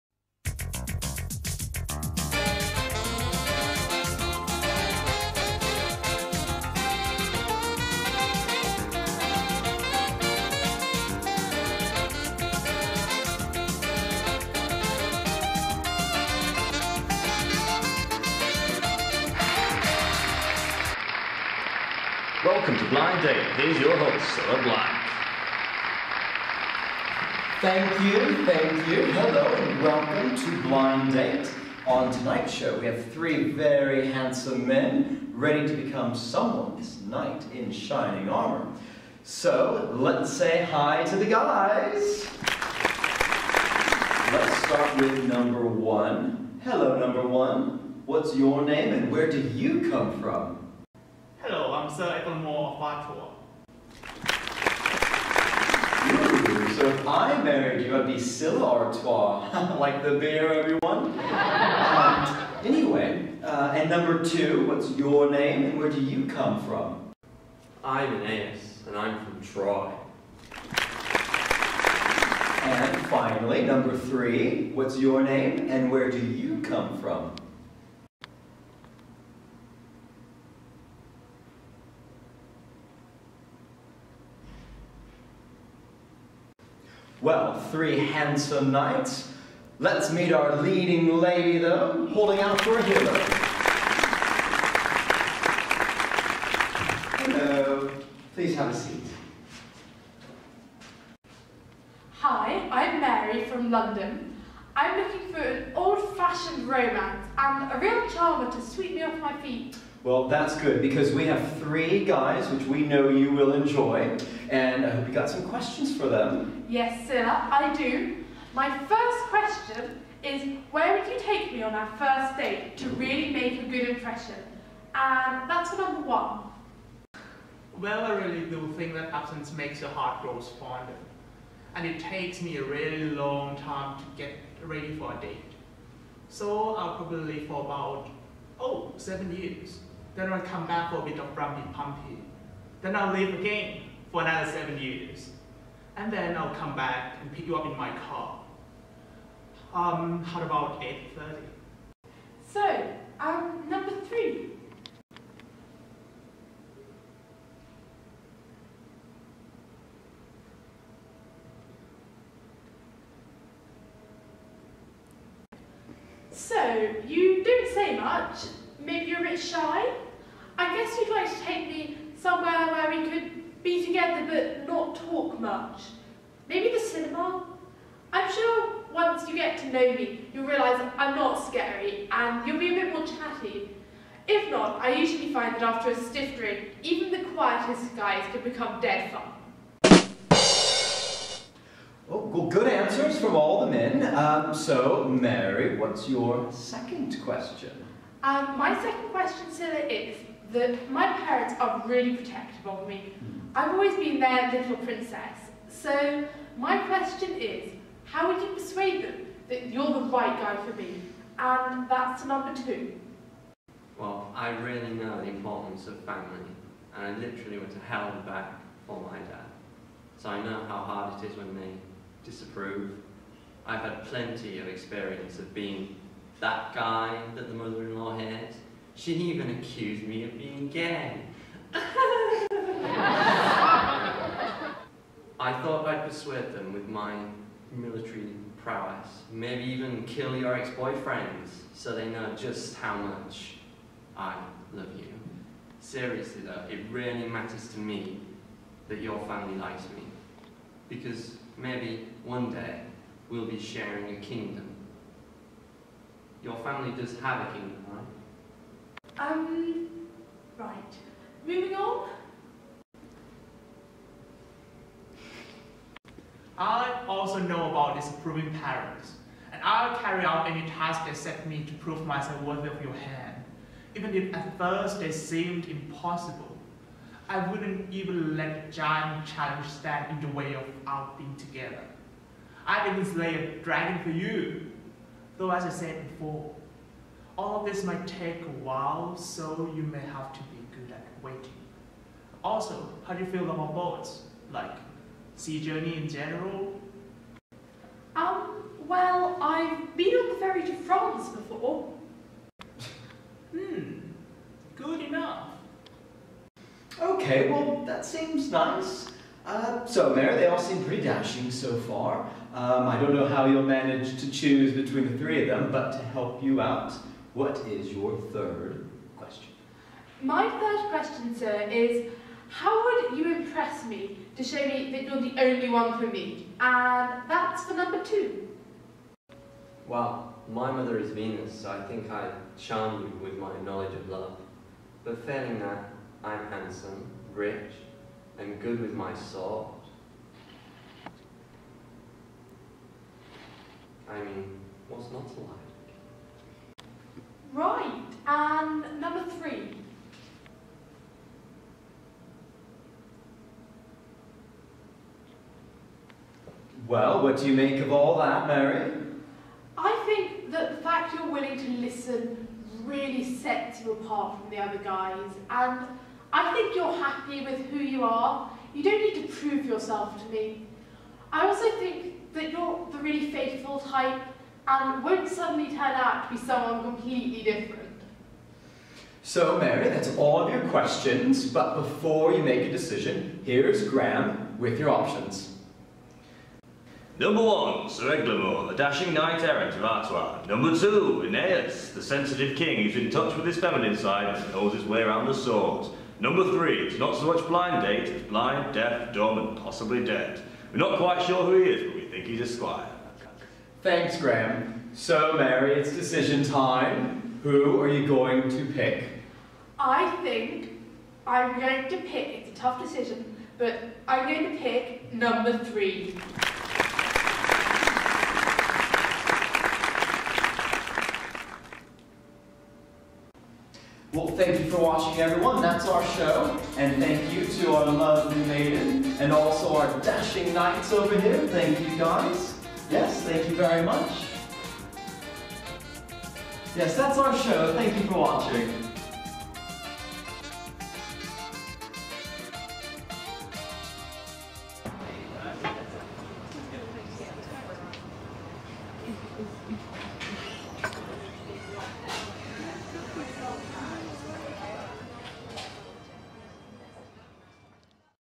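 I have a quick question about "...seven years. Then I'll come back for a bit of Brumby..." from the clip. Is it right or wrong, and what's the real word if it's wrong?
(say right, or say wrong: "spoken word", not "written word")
right.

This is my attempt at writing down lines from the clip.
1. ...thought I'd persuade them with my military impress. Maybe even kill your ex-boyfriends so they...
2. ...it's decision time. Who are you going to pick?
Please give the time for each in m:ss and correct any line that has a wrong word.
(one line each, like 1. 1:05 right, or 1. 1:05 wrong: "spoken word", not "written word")
1. 3:55 wrong: "prowess", not "impress"
2. 6:45 right.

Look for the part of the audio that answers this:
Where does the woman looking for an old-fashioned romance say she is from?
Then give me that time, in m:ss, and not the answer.
1:43.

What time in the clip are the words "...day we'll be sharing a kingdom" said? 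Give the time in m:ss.
4:12.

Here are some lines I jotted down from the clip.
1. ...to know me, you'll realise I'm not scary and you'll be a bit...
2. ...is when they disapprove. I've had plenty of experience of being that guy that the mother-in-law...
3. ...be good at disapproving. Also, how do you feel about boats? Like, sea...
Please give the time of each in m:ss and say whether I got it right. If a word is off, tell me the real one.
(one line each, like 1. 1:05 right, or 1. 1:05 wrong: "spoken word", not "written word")
1. 2:59 right
2. 3:41 right
3. 4:50 wrong: "waiting", not "disapproving".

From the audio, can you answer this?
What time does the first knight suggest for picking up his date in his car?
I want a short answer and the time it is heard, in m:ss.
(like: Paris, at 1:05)
8.30, at 2:30.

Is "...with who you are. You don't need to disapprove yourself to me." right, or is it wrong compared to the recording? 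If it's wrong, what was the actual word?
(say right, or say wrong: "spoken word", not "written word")
wrong: "prove", not "disapprove".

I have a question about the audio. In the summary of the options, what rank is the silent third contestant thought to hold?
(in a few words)
squire.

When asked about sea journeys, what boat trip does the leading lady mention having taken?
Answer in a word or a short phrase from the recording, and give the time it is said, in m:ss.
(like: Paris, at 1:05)
ferry to France, at 5:00.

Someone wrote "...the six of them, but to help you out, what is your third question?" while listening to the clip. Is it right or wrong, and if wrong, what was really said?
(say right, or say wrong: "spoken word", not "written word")
wrong: "three", not "six".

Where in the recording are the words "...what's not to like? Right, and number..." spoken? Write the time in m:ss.
5:44.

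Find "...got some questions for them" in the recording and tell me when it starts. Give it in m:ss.
1:55.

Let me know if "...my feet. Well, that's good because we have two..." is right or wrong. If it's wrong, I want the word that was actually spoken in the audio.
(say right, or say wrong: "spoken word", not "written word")
wrong: "three", not "two".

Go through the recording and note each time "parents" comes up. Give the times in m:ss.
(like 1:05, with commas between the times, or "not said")
3:21, 4:28.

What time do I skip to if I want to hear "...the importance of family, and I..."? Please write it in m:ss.
3:35.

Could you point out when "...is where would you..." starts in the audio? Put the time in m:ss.
2:00.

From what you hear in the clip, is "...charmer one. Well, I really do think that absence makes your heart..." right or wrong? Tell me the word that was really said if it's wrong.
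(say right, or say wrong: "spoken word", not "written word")
wrong: "number", not "charmer".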